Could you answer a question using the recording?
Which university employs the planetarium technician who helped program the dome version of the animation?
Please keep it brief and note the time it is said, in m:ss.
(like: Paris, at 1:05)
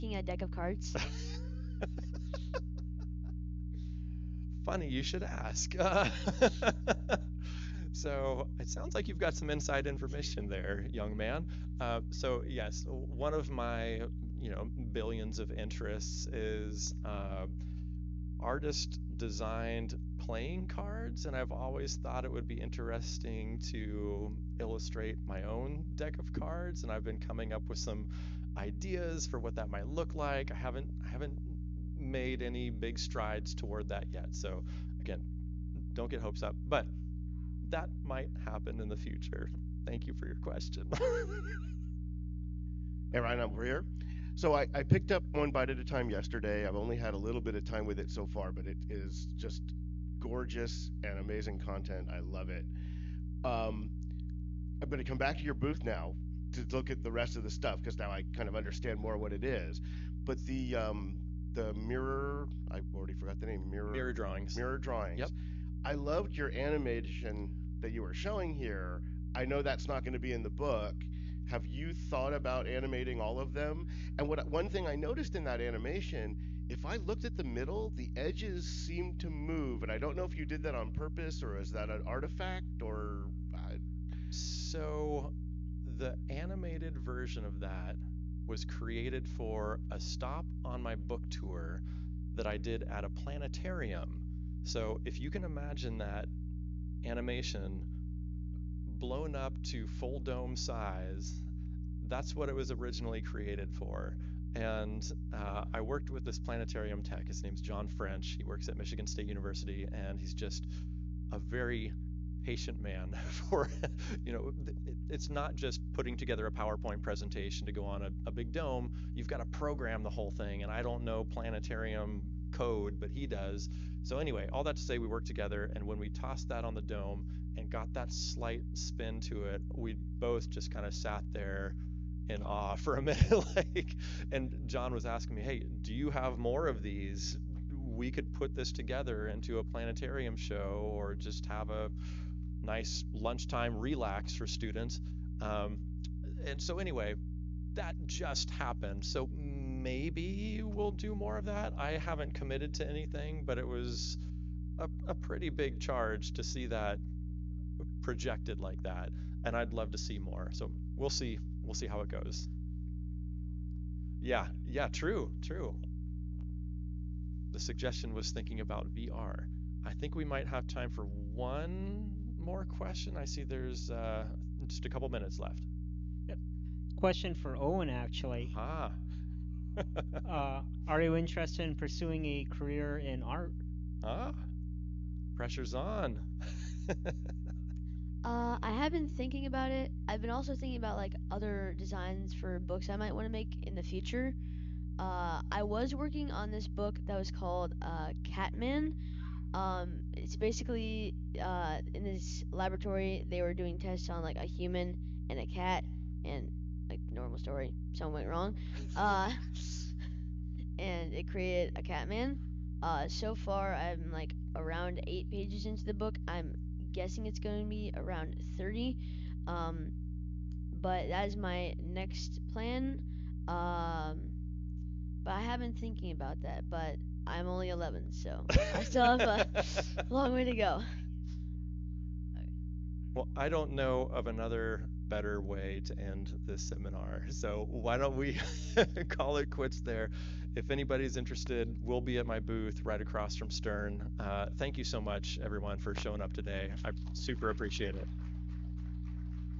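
Michigan State University, at 1:48.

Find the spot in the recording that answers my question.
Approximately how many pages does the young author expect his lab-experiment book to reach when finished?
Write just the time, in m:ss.
3:38.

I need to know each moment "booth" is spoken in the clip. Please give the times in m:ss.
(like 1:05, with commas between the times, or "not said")
0:55, 4:02.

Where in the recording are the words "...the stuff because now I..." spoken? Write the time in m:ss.
0:57.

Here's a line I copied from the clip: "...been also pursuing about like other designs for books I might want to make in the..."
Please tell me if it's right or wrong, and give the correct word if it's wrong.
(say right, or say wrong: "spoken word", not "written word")
wrong: "thinking", not "pursuing".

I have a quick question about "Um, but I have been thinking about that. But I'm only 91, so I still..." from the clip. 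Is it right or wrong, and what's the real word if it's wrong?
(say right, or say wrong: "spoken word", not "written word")
wrong: "11", not "91".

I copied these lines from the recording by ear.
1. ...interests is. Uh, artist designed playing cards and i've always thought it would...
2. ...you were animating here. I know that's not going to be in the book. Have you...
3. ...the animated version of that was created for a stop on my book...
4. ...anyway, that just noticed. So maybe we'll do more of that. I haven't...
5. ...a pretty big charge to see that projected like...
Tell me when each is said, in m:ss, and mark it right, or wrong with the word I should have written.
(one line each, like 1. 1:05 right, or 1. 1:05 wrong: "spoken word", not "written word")
1. 0:15 right
2. 1:07 wrong: "showing", not "animating"
3. 1:25 right
4. 2:26 wrong: "happened", not "noticed"
5. 2:35 right.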